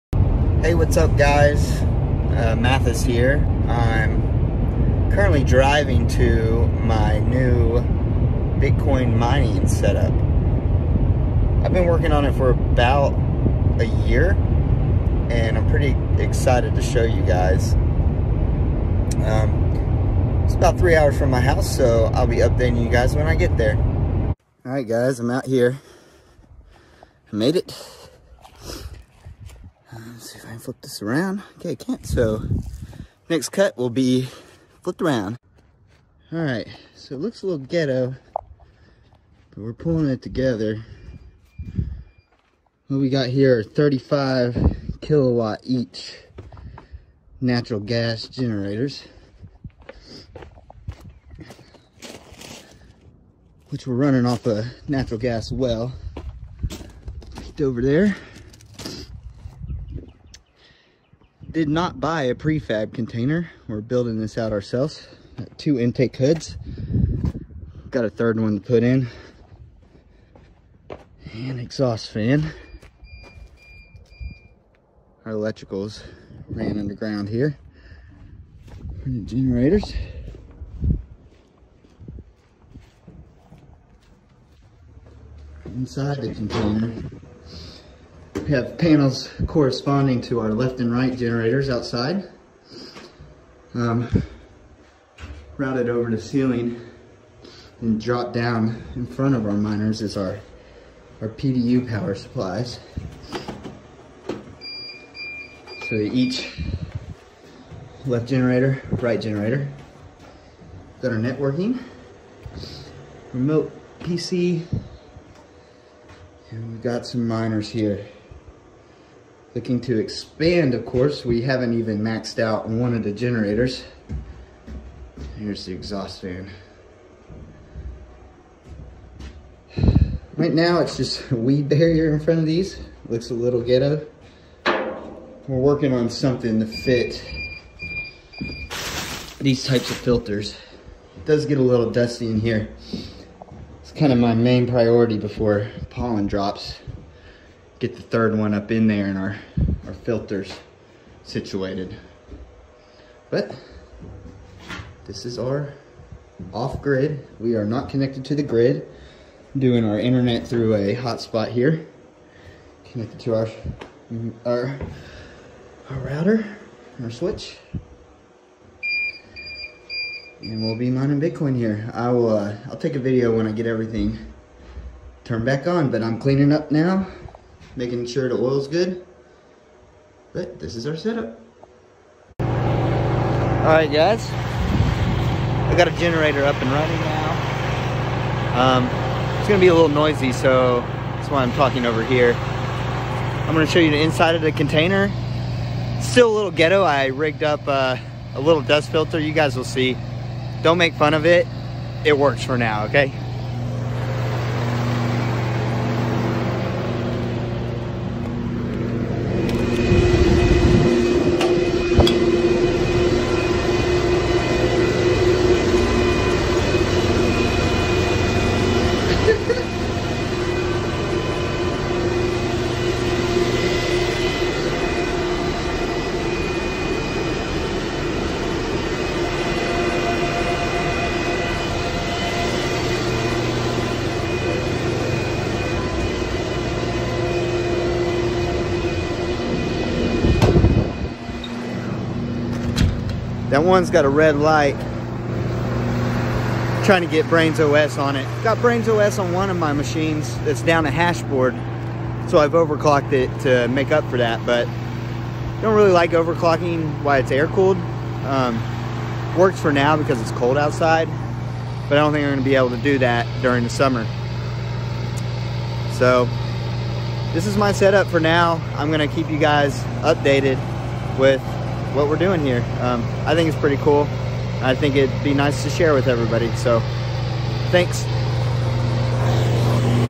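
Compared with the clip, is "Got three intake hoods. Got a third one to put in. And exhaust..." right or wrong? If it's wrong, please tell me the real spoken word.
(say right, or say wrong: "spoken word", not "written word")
wrong: "two", not "three".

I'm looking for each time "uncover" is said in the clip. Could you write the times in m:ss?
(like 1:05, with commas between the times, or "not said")
not said.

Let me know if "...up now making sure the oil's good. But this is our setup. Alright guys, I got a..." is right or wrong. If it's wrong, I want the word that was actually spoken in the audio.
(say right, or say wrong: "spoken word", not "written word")
right.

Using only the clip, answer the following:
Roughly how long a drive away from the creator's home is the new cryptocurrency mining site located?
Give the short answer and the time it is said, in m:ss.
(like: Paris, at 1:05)
3 hours, at 0:20.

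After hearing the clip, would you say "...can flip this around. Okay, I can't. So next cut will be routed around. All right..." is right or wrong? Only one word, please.
wrong.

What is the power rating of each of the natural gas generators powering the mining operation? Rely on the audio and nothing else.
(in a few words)
35 kilowatts.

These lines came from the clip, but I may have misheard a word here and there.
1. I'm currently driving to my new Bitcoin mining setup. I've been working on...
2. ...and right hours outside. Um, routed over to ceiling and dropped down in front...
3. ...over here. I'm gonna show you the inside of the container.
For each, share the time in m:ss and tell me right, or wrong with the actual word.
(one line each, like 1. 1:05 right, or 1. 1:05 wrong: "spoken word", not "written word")
1. 0:03 right
2. 1:30 wrong: "generators", not "hours"
3. 3:11 right.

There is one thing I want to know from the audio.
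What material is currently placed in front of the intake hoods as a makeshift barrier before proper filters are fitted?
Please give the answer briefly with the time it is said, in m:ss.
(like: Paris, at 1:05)
Weed barrier, at 2:11.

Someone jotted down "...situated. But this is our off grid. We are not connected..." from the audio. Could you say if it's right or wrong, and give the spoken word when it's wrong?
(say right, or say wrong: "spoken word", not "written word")
right.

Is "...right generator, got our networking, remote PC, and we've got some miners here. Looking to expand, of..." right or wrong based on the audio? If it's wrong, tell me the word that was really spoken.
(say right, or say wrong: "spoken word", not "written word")
right.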